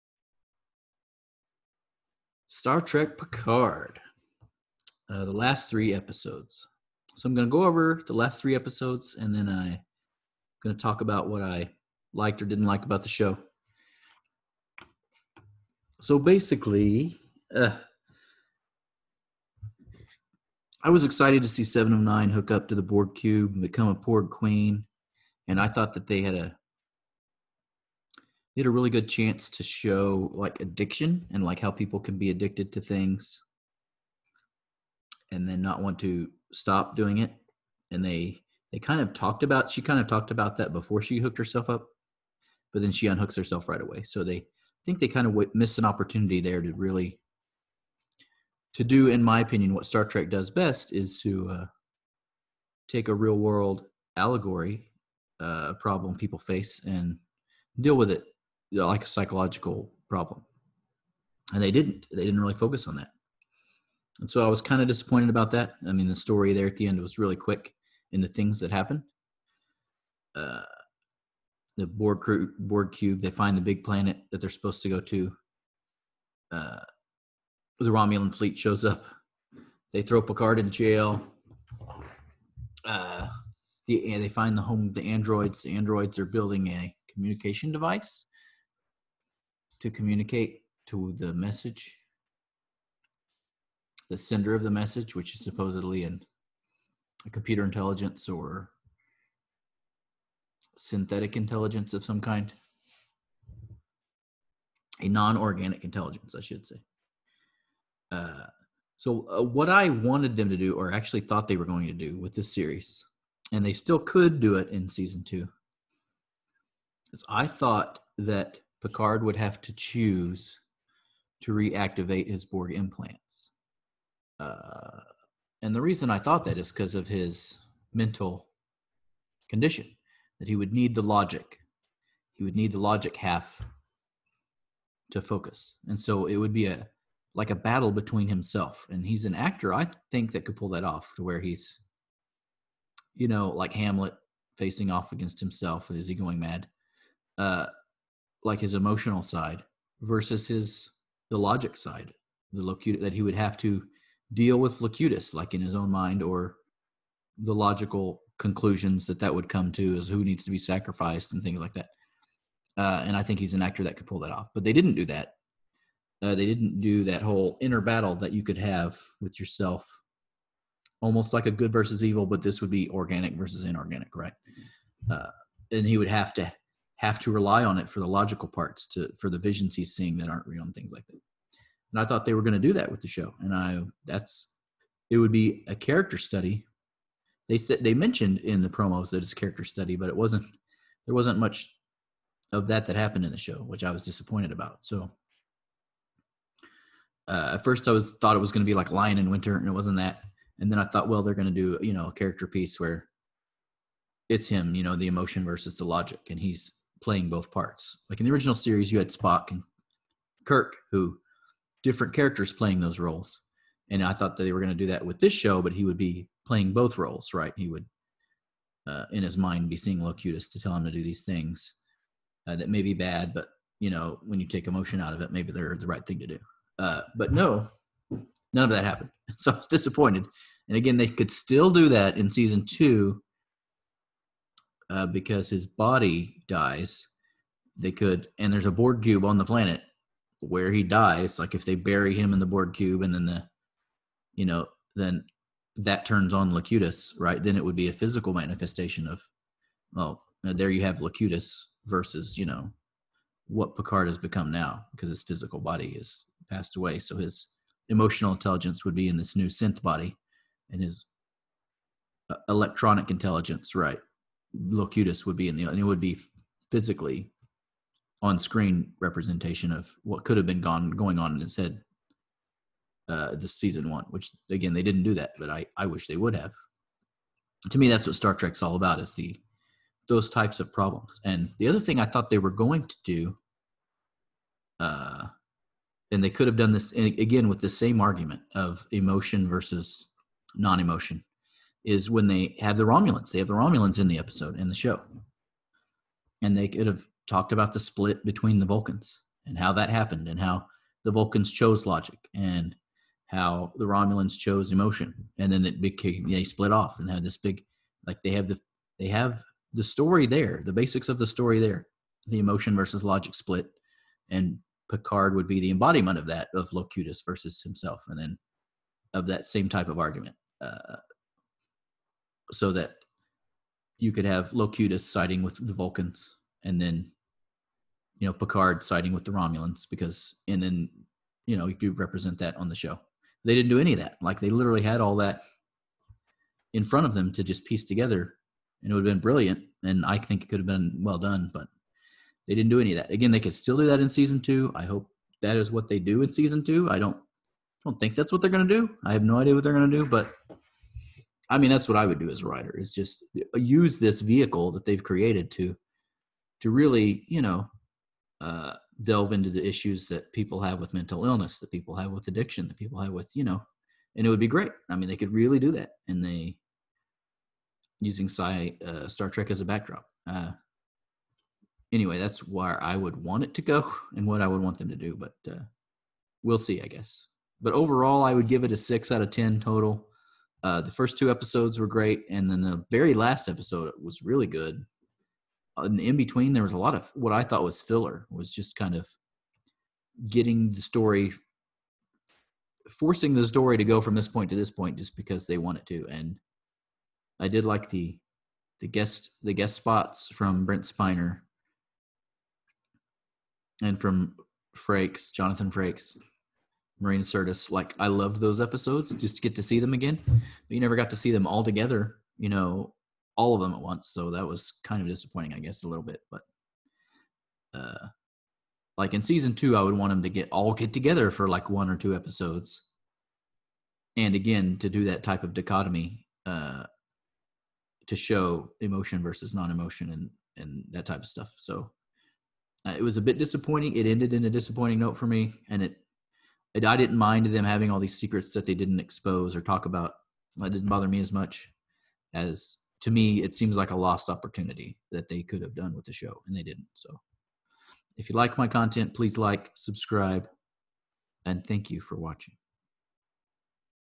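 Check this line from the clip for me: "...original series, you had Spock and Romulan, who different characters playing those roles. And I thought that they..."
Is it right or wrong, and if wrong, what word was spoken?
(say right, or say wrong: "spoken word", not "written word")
wrong: "Kirk", not "Romulan".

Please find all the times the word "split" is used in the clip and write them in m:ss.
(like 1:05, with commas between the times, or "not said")
4:57, 5:06, 5:13.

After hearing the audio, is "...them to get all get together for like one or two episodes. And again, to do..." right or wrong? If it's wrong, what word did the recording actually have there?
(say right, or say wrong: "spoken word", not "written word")
right.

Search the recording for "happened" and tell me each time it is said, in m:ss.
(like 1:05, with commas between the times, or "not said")
1:08, 3:12, 3:48, 4:59.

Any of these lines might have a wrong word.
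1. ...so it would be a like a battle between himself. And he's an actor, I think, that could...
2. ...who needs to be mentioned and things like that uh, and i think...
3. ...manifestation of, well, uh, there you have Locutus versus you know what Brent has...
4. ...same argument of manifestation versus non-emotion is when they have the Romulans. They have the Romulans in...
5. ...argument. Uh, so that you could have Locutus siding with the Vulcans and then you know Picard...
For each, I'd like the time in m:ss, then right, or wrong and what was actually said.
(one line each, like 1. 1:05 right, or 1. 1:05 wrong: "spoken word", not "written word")
1. 2:15 right
2. 2:40 wrong: "sacrificed", not "mentioned"
3. 4:08 wrong: "Picard", not "Brent"
4. 4:47 wrong: "emotion", not "manifestation"
5. 5:19 right.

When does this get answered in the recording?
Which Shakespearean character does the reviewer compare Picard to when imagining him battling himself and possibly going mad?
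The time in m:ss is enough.
2:23.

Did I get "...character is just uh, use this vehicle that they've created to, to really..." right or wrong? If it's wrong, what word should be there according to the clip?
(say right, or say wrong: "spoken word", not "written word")
wrong: "writer", not "character".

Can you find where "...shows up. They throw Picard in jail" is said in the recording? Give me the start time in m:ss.
1:18.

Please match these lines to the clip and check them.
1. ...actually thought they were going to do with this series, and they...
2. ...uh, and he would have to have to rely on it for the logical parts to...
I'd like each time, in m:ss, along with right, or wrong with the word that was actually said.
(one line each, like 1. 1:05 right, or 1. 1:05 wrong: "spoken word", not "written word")
1. 1:50 right
2. 2:55 right.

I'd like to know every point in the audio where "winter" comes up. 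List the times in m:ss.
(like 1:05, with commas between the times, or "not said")
3:19.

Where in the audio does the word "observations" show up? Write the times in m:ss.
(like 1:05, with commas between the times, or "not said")
not said.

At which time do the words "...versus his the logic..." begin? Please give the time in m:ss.
2:30.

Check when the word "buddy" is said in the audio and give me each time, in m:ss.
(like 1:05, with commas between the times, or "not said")
not said.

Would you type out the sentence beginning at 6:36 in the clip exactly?
And I did like the the guest the guest spots from Brent Spiner and from Frakes, Jonathan Frakes.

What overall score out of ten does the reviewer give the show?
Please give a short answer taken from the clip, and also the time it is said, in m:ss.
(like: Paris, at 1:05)
6, at 6:18.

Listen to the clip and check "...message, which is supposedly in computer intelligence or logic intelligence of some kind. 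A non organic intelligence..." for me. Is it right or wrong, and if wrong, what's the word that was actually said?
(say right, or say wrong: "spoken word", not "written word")
wrong: "synthetic", not "logic".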